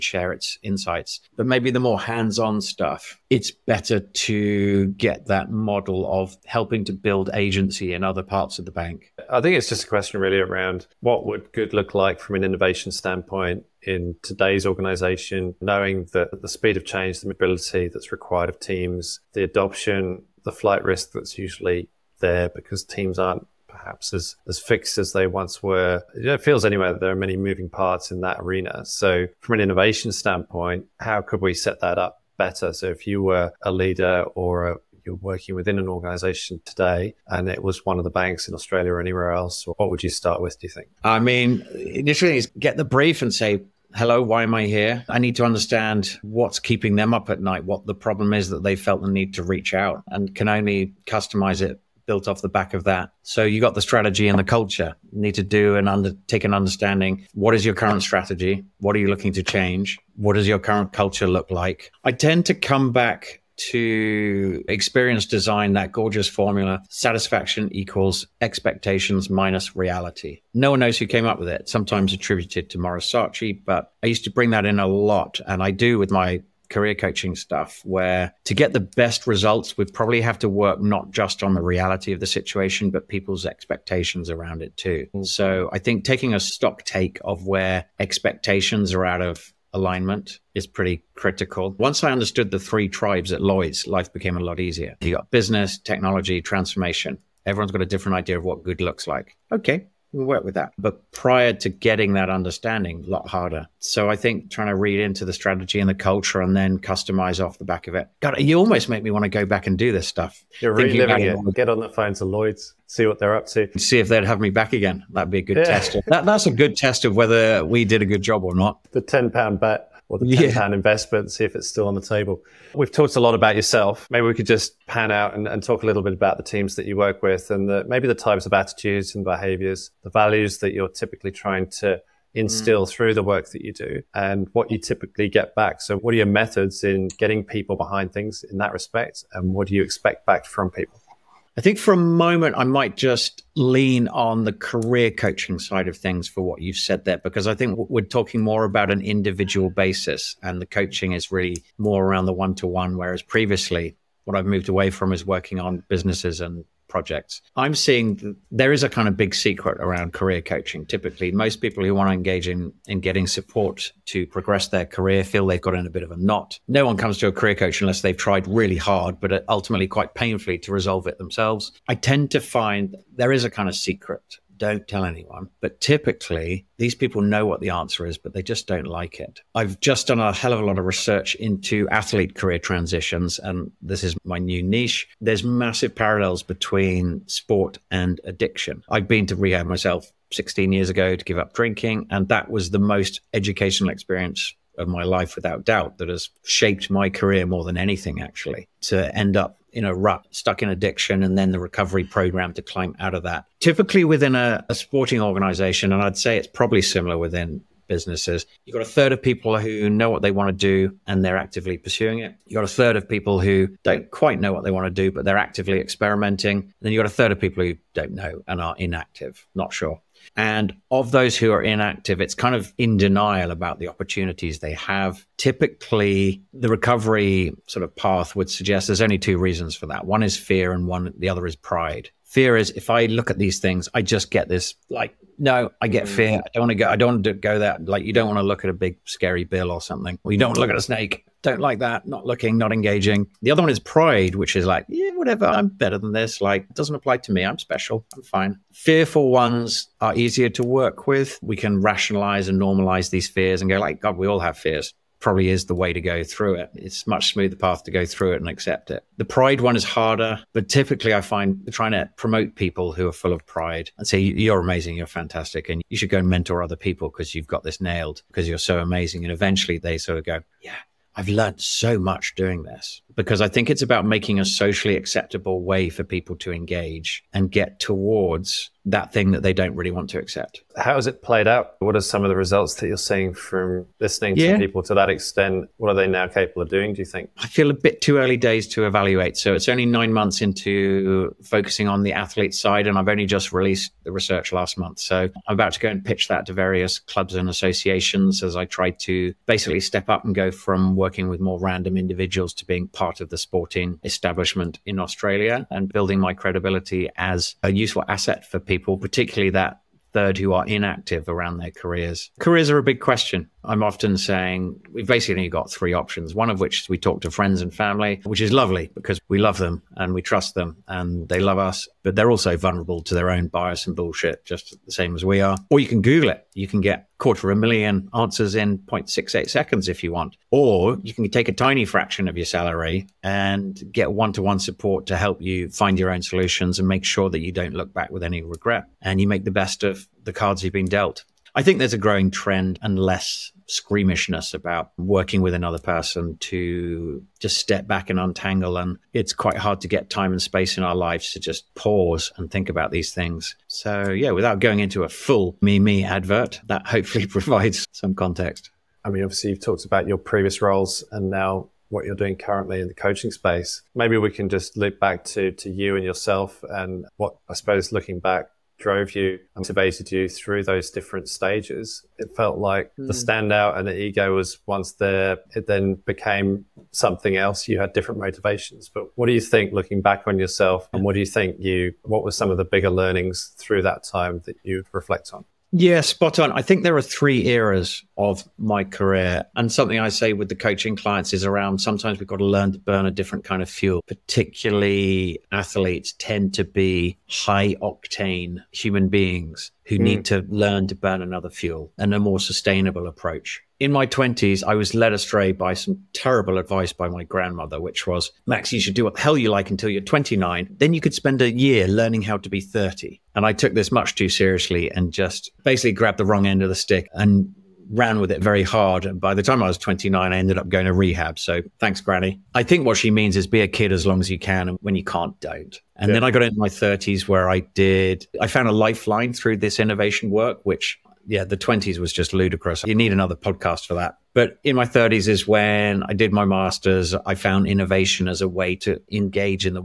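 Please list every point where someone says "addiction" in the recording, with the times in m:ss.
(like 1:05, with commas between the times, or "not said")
3:08, 3:20.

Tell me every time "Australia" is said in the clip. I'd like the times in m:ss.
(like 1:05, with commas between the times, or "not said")
0:38, 5:05.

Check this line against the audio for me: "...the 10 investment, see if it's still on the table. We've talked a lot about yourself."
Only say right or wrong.
right.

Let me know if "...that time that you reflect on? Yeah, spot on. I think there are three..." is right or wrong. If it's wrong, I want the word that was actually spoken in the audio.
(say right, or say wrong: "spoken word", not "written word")
right.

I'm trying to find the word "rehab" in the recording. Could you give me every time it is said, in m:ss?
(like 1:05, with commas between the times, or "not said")
3:09, 7:00.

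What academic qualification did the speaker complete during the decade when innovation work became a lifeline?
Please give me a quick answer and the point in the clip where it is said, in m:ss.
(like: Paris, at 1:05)
master's, at 7:16.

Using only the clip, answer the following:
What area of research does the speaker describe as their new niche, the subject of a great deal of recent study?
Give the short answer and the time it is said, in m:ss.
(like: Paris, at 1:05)
athlete career transitions, at 3:01.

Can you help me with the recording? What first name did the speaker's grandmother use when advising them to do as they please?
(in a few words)
Max.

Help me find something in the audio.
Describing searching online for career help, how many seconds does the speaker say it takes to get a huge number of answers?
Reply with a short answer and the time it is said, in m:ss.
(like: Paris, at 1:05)
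0.68, at 5:28.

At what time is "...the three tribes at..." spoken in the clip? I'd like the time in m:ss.
1:32.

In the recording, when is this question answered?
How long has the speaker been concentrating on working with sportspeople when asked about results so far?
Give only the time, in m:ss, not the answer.
4:49.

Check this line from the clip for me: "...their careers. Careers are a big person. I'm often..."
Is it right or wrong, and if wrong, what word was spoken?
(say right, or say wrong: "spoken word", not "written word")
wrong: "question", not "person".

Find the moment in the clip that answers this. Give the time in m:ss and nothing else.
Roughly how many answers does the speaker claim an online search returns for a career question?
5:27.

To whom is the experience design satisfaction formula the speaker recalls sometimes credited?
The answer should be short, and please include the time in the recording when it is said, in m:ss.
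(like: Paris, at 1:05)
Morisachi, at 1:12.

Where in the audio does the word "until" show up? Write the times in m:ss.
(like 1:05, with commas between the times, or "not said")
6:49.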